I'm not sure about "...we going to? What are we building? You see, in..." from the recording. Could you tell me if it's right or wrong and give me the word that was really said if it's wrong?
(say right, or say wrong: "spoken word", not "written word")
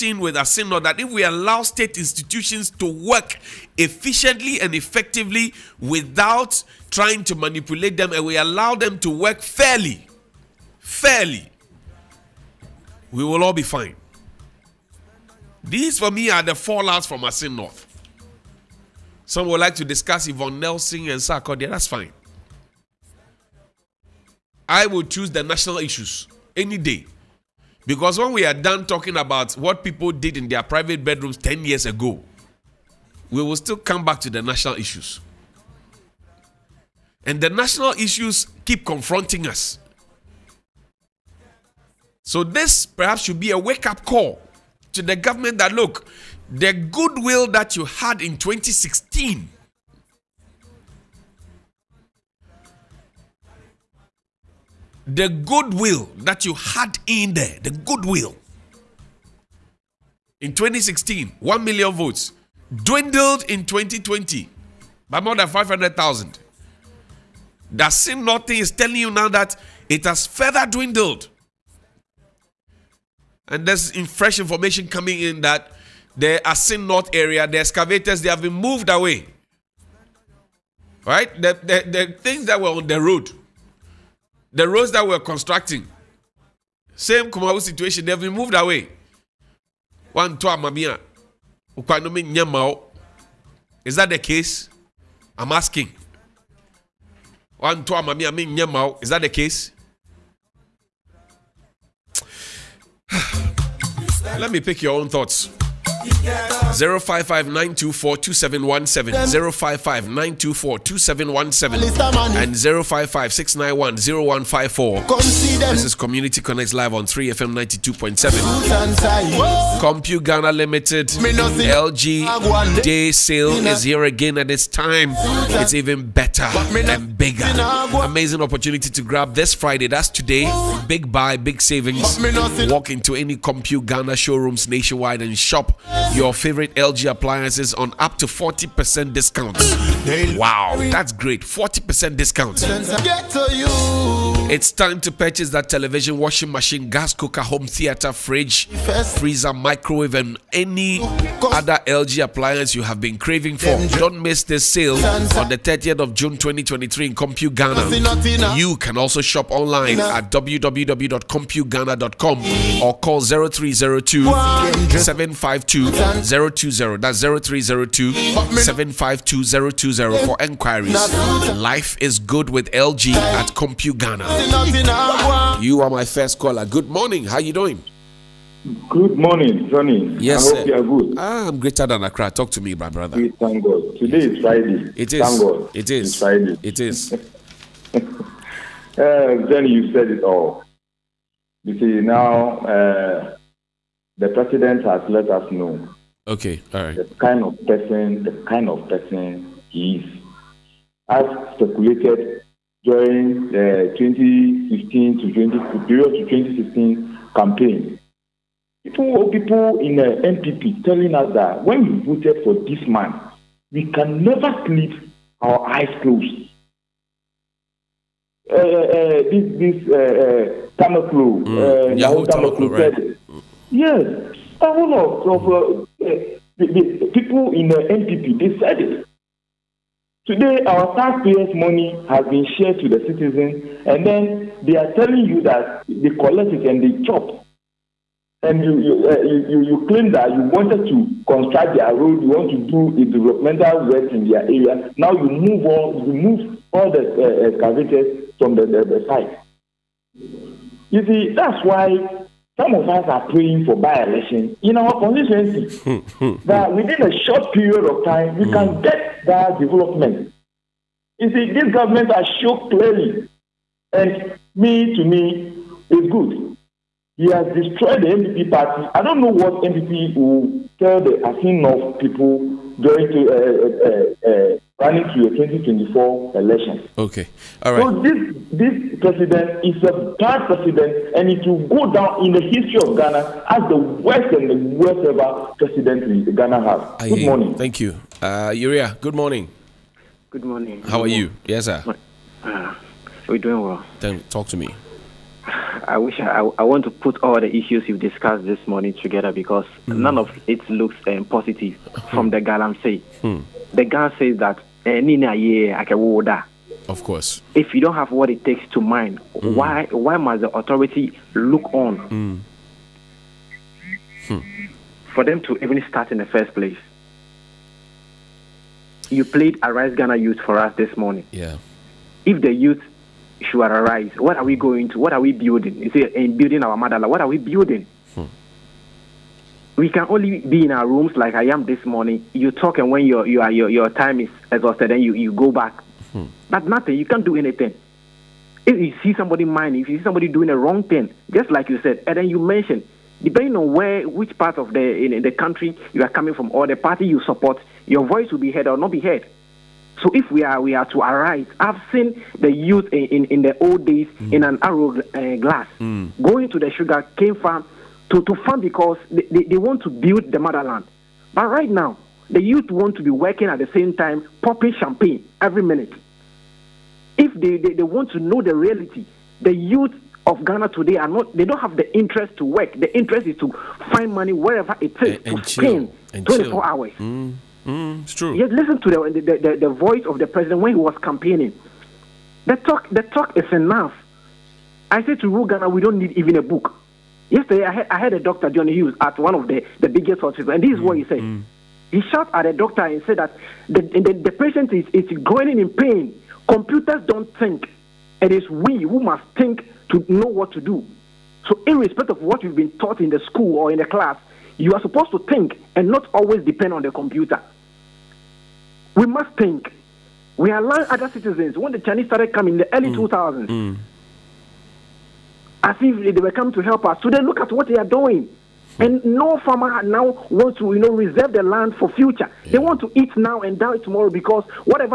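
right.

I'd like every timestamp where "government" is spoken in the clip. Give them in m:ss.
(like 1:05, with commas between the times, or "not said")
0:45, 4:21.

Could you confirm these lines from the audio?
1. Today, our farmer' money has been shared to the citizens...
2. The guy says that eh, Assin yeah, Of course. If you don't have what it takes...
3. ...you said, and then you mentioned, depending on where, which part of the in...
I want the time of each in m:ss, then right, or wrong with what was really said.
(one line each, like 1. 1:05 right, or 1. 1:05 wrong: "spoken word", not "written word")
1. 3:50 wrong: "taxpayers", not "farmer"
2. 5:03 wrong: "Nina", not "Assin"
3. 5:41 right.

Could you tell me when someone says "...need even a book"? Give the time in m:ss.
6:25.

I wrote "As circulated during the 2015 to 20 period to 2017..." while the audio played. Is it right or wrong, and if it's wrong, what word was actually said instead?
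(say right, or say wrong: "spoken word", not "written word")
wrong: "2016", not "2017".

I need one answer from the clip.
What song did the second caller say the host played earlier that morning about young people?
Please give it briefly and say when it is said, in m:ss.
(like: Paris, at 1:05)
Arise Ghana Youth, at 5:19.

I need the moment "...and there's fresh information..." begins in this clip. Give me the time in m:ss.
1:13.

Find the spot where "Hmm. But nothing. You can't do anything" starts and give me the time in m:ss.
5:36.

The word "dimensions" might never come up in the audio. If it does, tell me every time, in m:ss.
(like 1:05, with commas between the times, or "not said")
not said.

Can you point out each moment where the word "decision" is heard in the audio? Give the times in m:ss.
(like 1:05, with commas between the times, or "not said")
not said.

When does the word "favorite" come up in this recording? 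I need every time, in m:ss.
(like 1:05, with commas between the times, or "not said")
2:16.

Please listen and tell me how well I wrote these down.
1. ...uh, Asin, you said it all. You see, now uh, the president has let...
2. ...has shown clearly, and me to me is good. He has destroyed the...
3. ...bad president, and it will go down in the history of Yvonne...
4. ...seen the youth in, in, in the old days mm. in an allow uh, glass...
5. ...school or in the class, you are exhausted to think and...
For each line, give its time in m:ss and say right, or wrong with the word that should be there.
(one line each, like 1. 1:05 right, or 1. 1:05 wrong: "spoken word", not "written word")
1. 3:07 wrong: "Johnny", not "Asin"
2. 4:22 right
3. 4:40 wrong: "Ghana", not "Yvonne"
4. 5:51 wrong: "arrow", not "allow"
5. 6:43 wrong: "supposed", not "exhausted".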